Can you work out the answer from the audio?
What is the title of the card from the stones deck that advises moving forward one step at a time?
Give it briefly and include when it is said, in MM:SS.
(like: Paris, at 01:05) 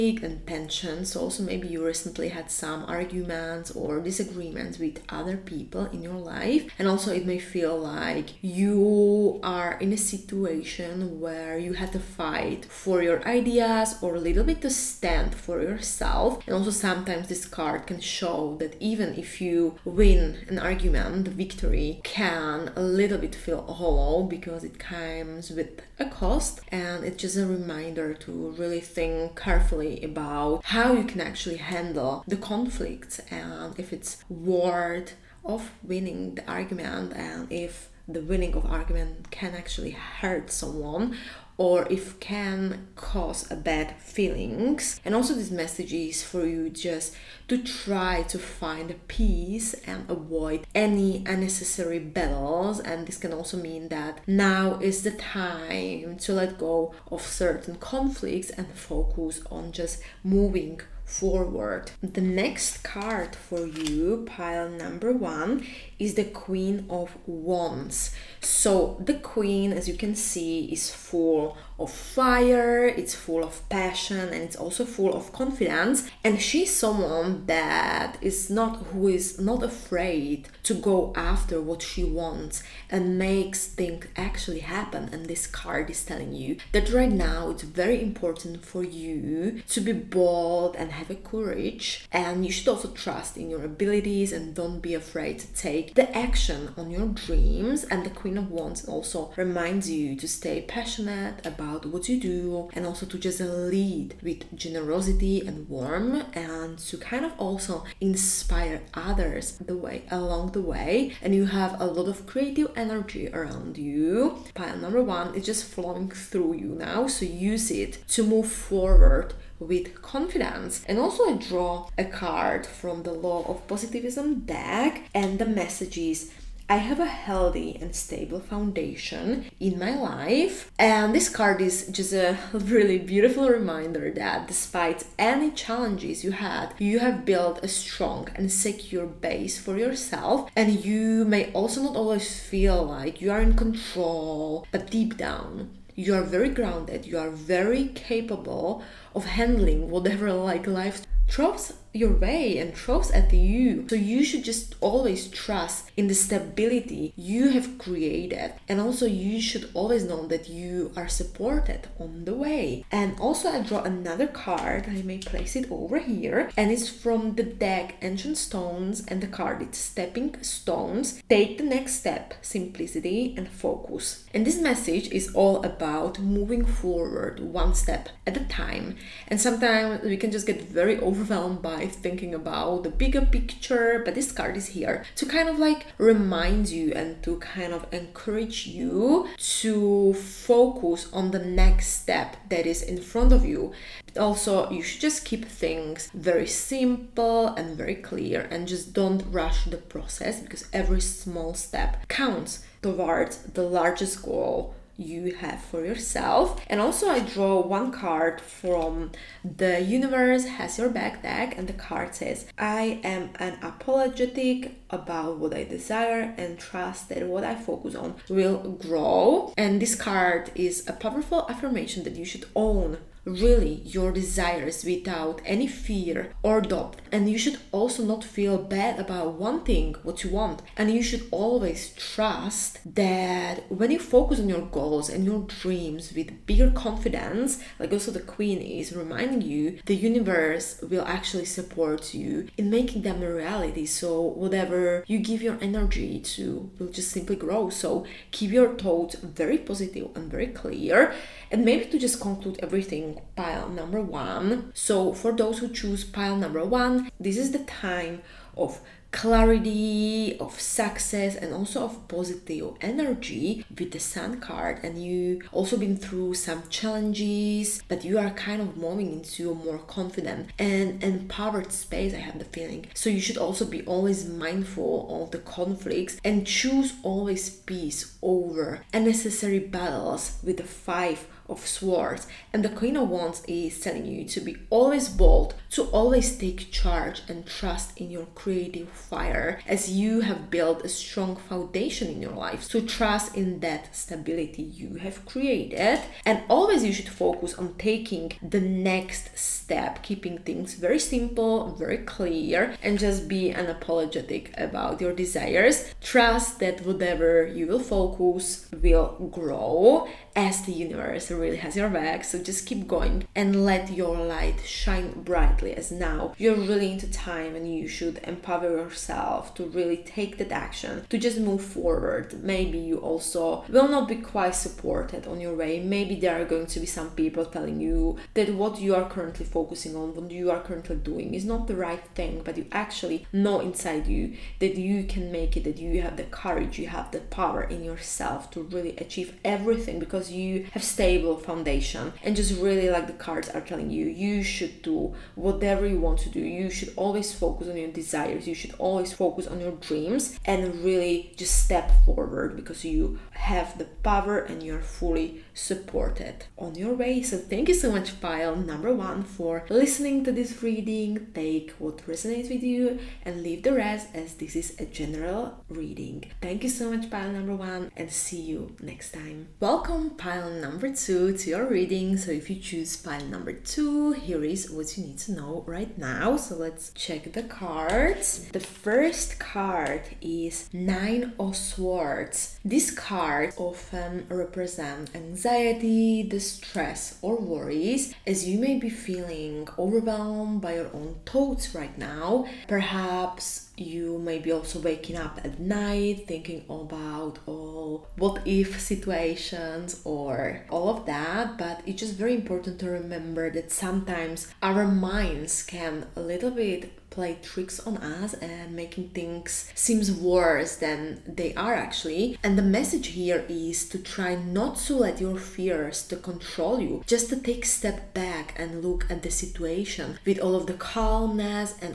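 Stepping Stones, at 02:49.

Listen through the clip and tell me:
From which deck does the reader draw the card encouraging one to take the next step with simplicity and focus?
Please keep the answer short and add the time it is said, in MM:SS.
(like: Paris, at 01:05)
Ancient Stones, at 02:48.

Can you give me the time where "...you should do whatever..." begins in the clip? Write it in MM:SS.
05:44.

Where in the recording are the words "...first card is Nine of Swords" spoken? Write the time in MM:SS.
06:18.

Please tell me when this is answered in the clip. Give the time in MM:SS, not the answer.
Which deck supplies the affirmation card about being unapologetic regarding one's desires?
03:29.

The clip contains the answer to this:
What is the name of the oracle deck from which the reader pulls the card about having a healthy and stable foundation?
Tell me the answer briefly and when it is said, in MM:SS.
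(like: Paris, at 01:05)
Law of Positivism, at 02:03.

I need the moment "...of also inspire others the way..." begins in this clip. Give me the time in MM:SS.
01:47.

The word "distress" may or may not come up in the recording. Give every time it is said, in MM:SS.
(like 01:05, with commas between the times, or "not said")
06:26.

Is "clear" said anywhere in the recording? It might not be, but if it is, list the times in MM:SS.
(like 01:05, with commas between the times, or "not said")
03:17, 04:10, 05:01.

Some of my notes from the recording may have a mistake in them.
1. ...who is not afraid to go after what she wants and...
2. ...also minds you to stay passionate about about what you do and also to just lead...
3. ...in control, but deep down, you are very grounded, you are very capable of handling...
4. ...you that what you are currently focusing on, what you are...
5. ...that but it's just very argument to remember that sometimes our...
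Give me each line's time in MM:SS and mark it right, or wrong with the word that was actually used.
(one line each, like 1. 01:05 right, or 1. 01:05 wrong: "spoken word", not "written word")
1. 01:18 right
2. 01:38 wrong: "reminds", not "minds"
3. 02:23 right
4. 05:27 right
5. 06:41 wrong: "important", not "argument".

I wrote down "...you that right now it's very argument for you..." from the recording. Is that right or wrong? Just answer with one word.
wrong.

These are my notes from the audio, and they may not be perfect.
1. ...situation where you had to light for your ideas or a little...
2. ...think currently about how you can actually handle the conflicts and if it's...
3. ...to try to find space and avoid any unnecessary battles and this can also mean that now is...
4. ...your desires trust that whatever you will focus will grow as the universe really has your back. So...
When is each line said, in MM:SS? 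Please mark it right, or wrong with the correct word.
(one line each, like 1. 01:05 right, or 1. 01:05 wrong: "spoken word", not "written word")
1. 00:09 wrong: "fight", not "light"
2. 00:28 wrong: "carefully", not "currently"
3. 00:47 wrong: "peace", not "space"
4. 05:04 right.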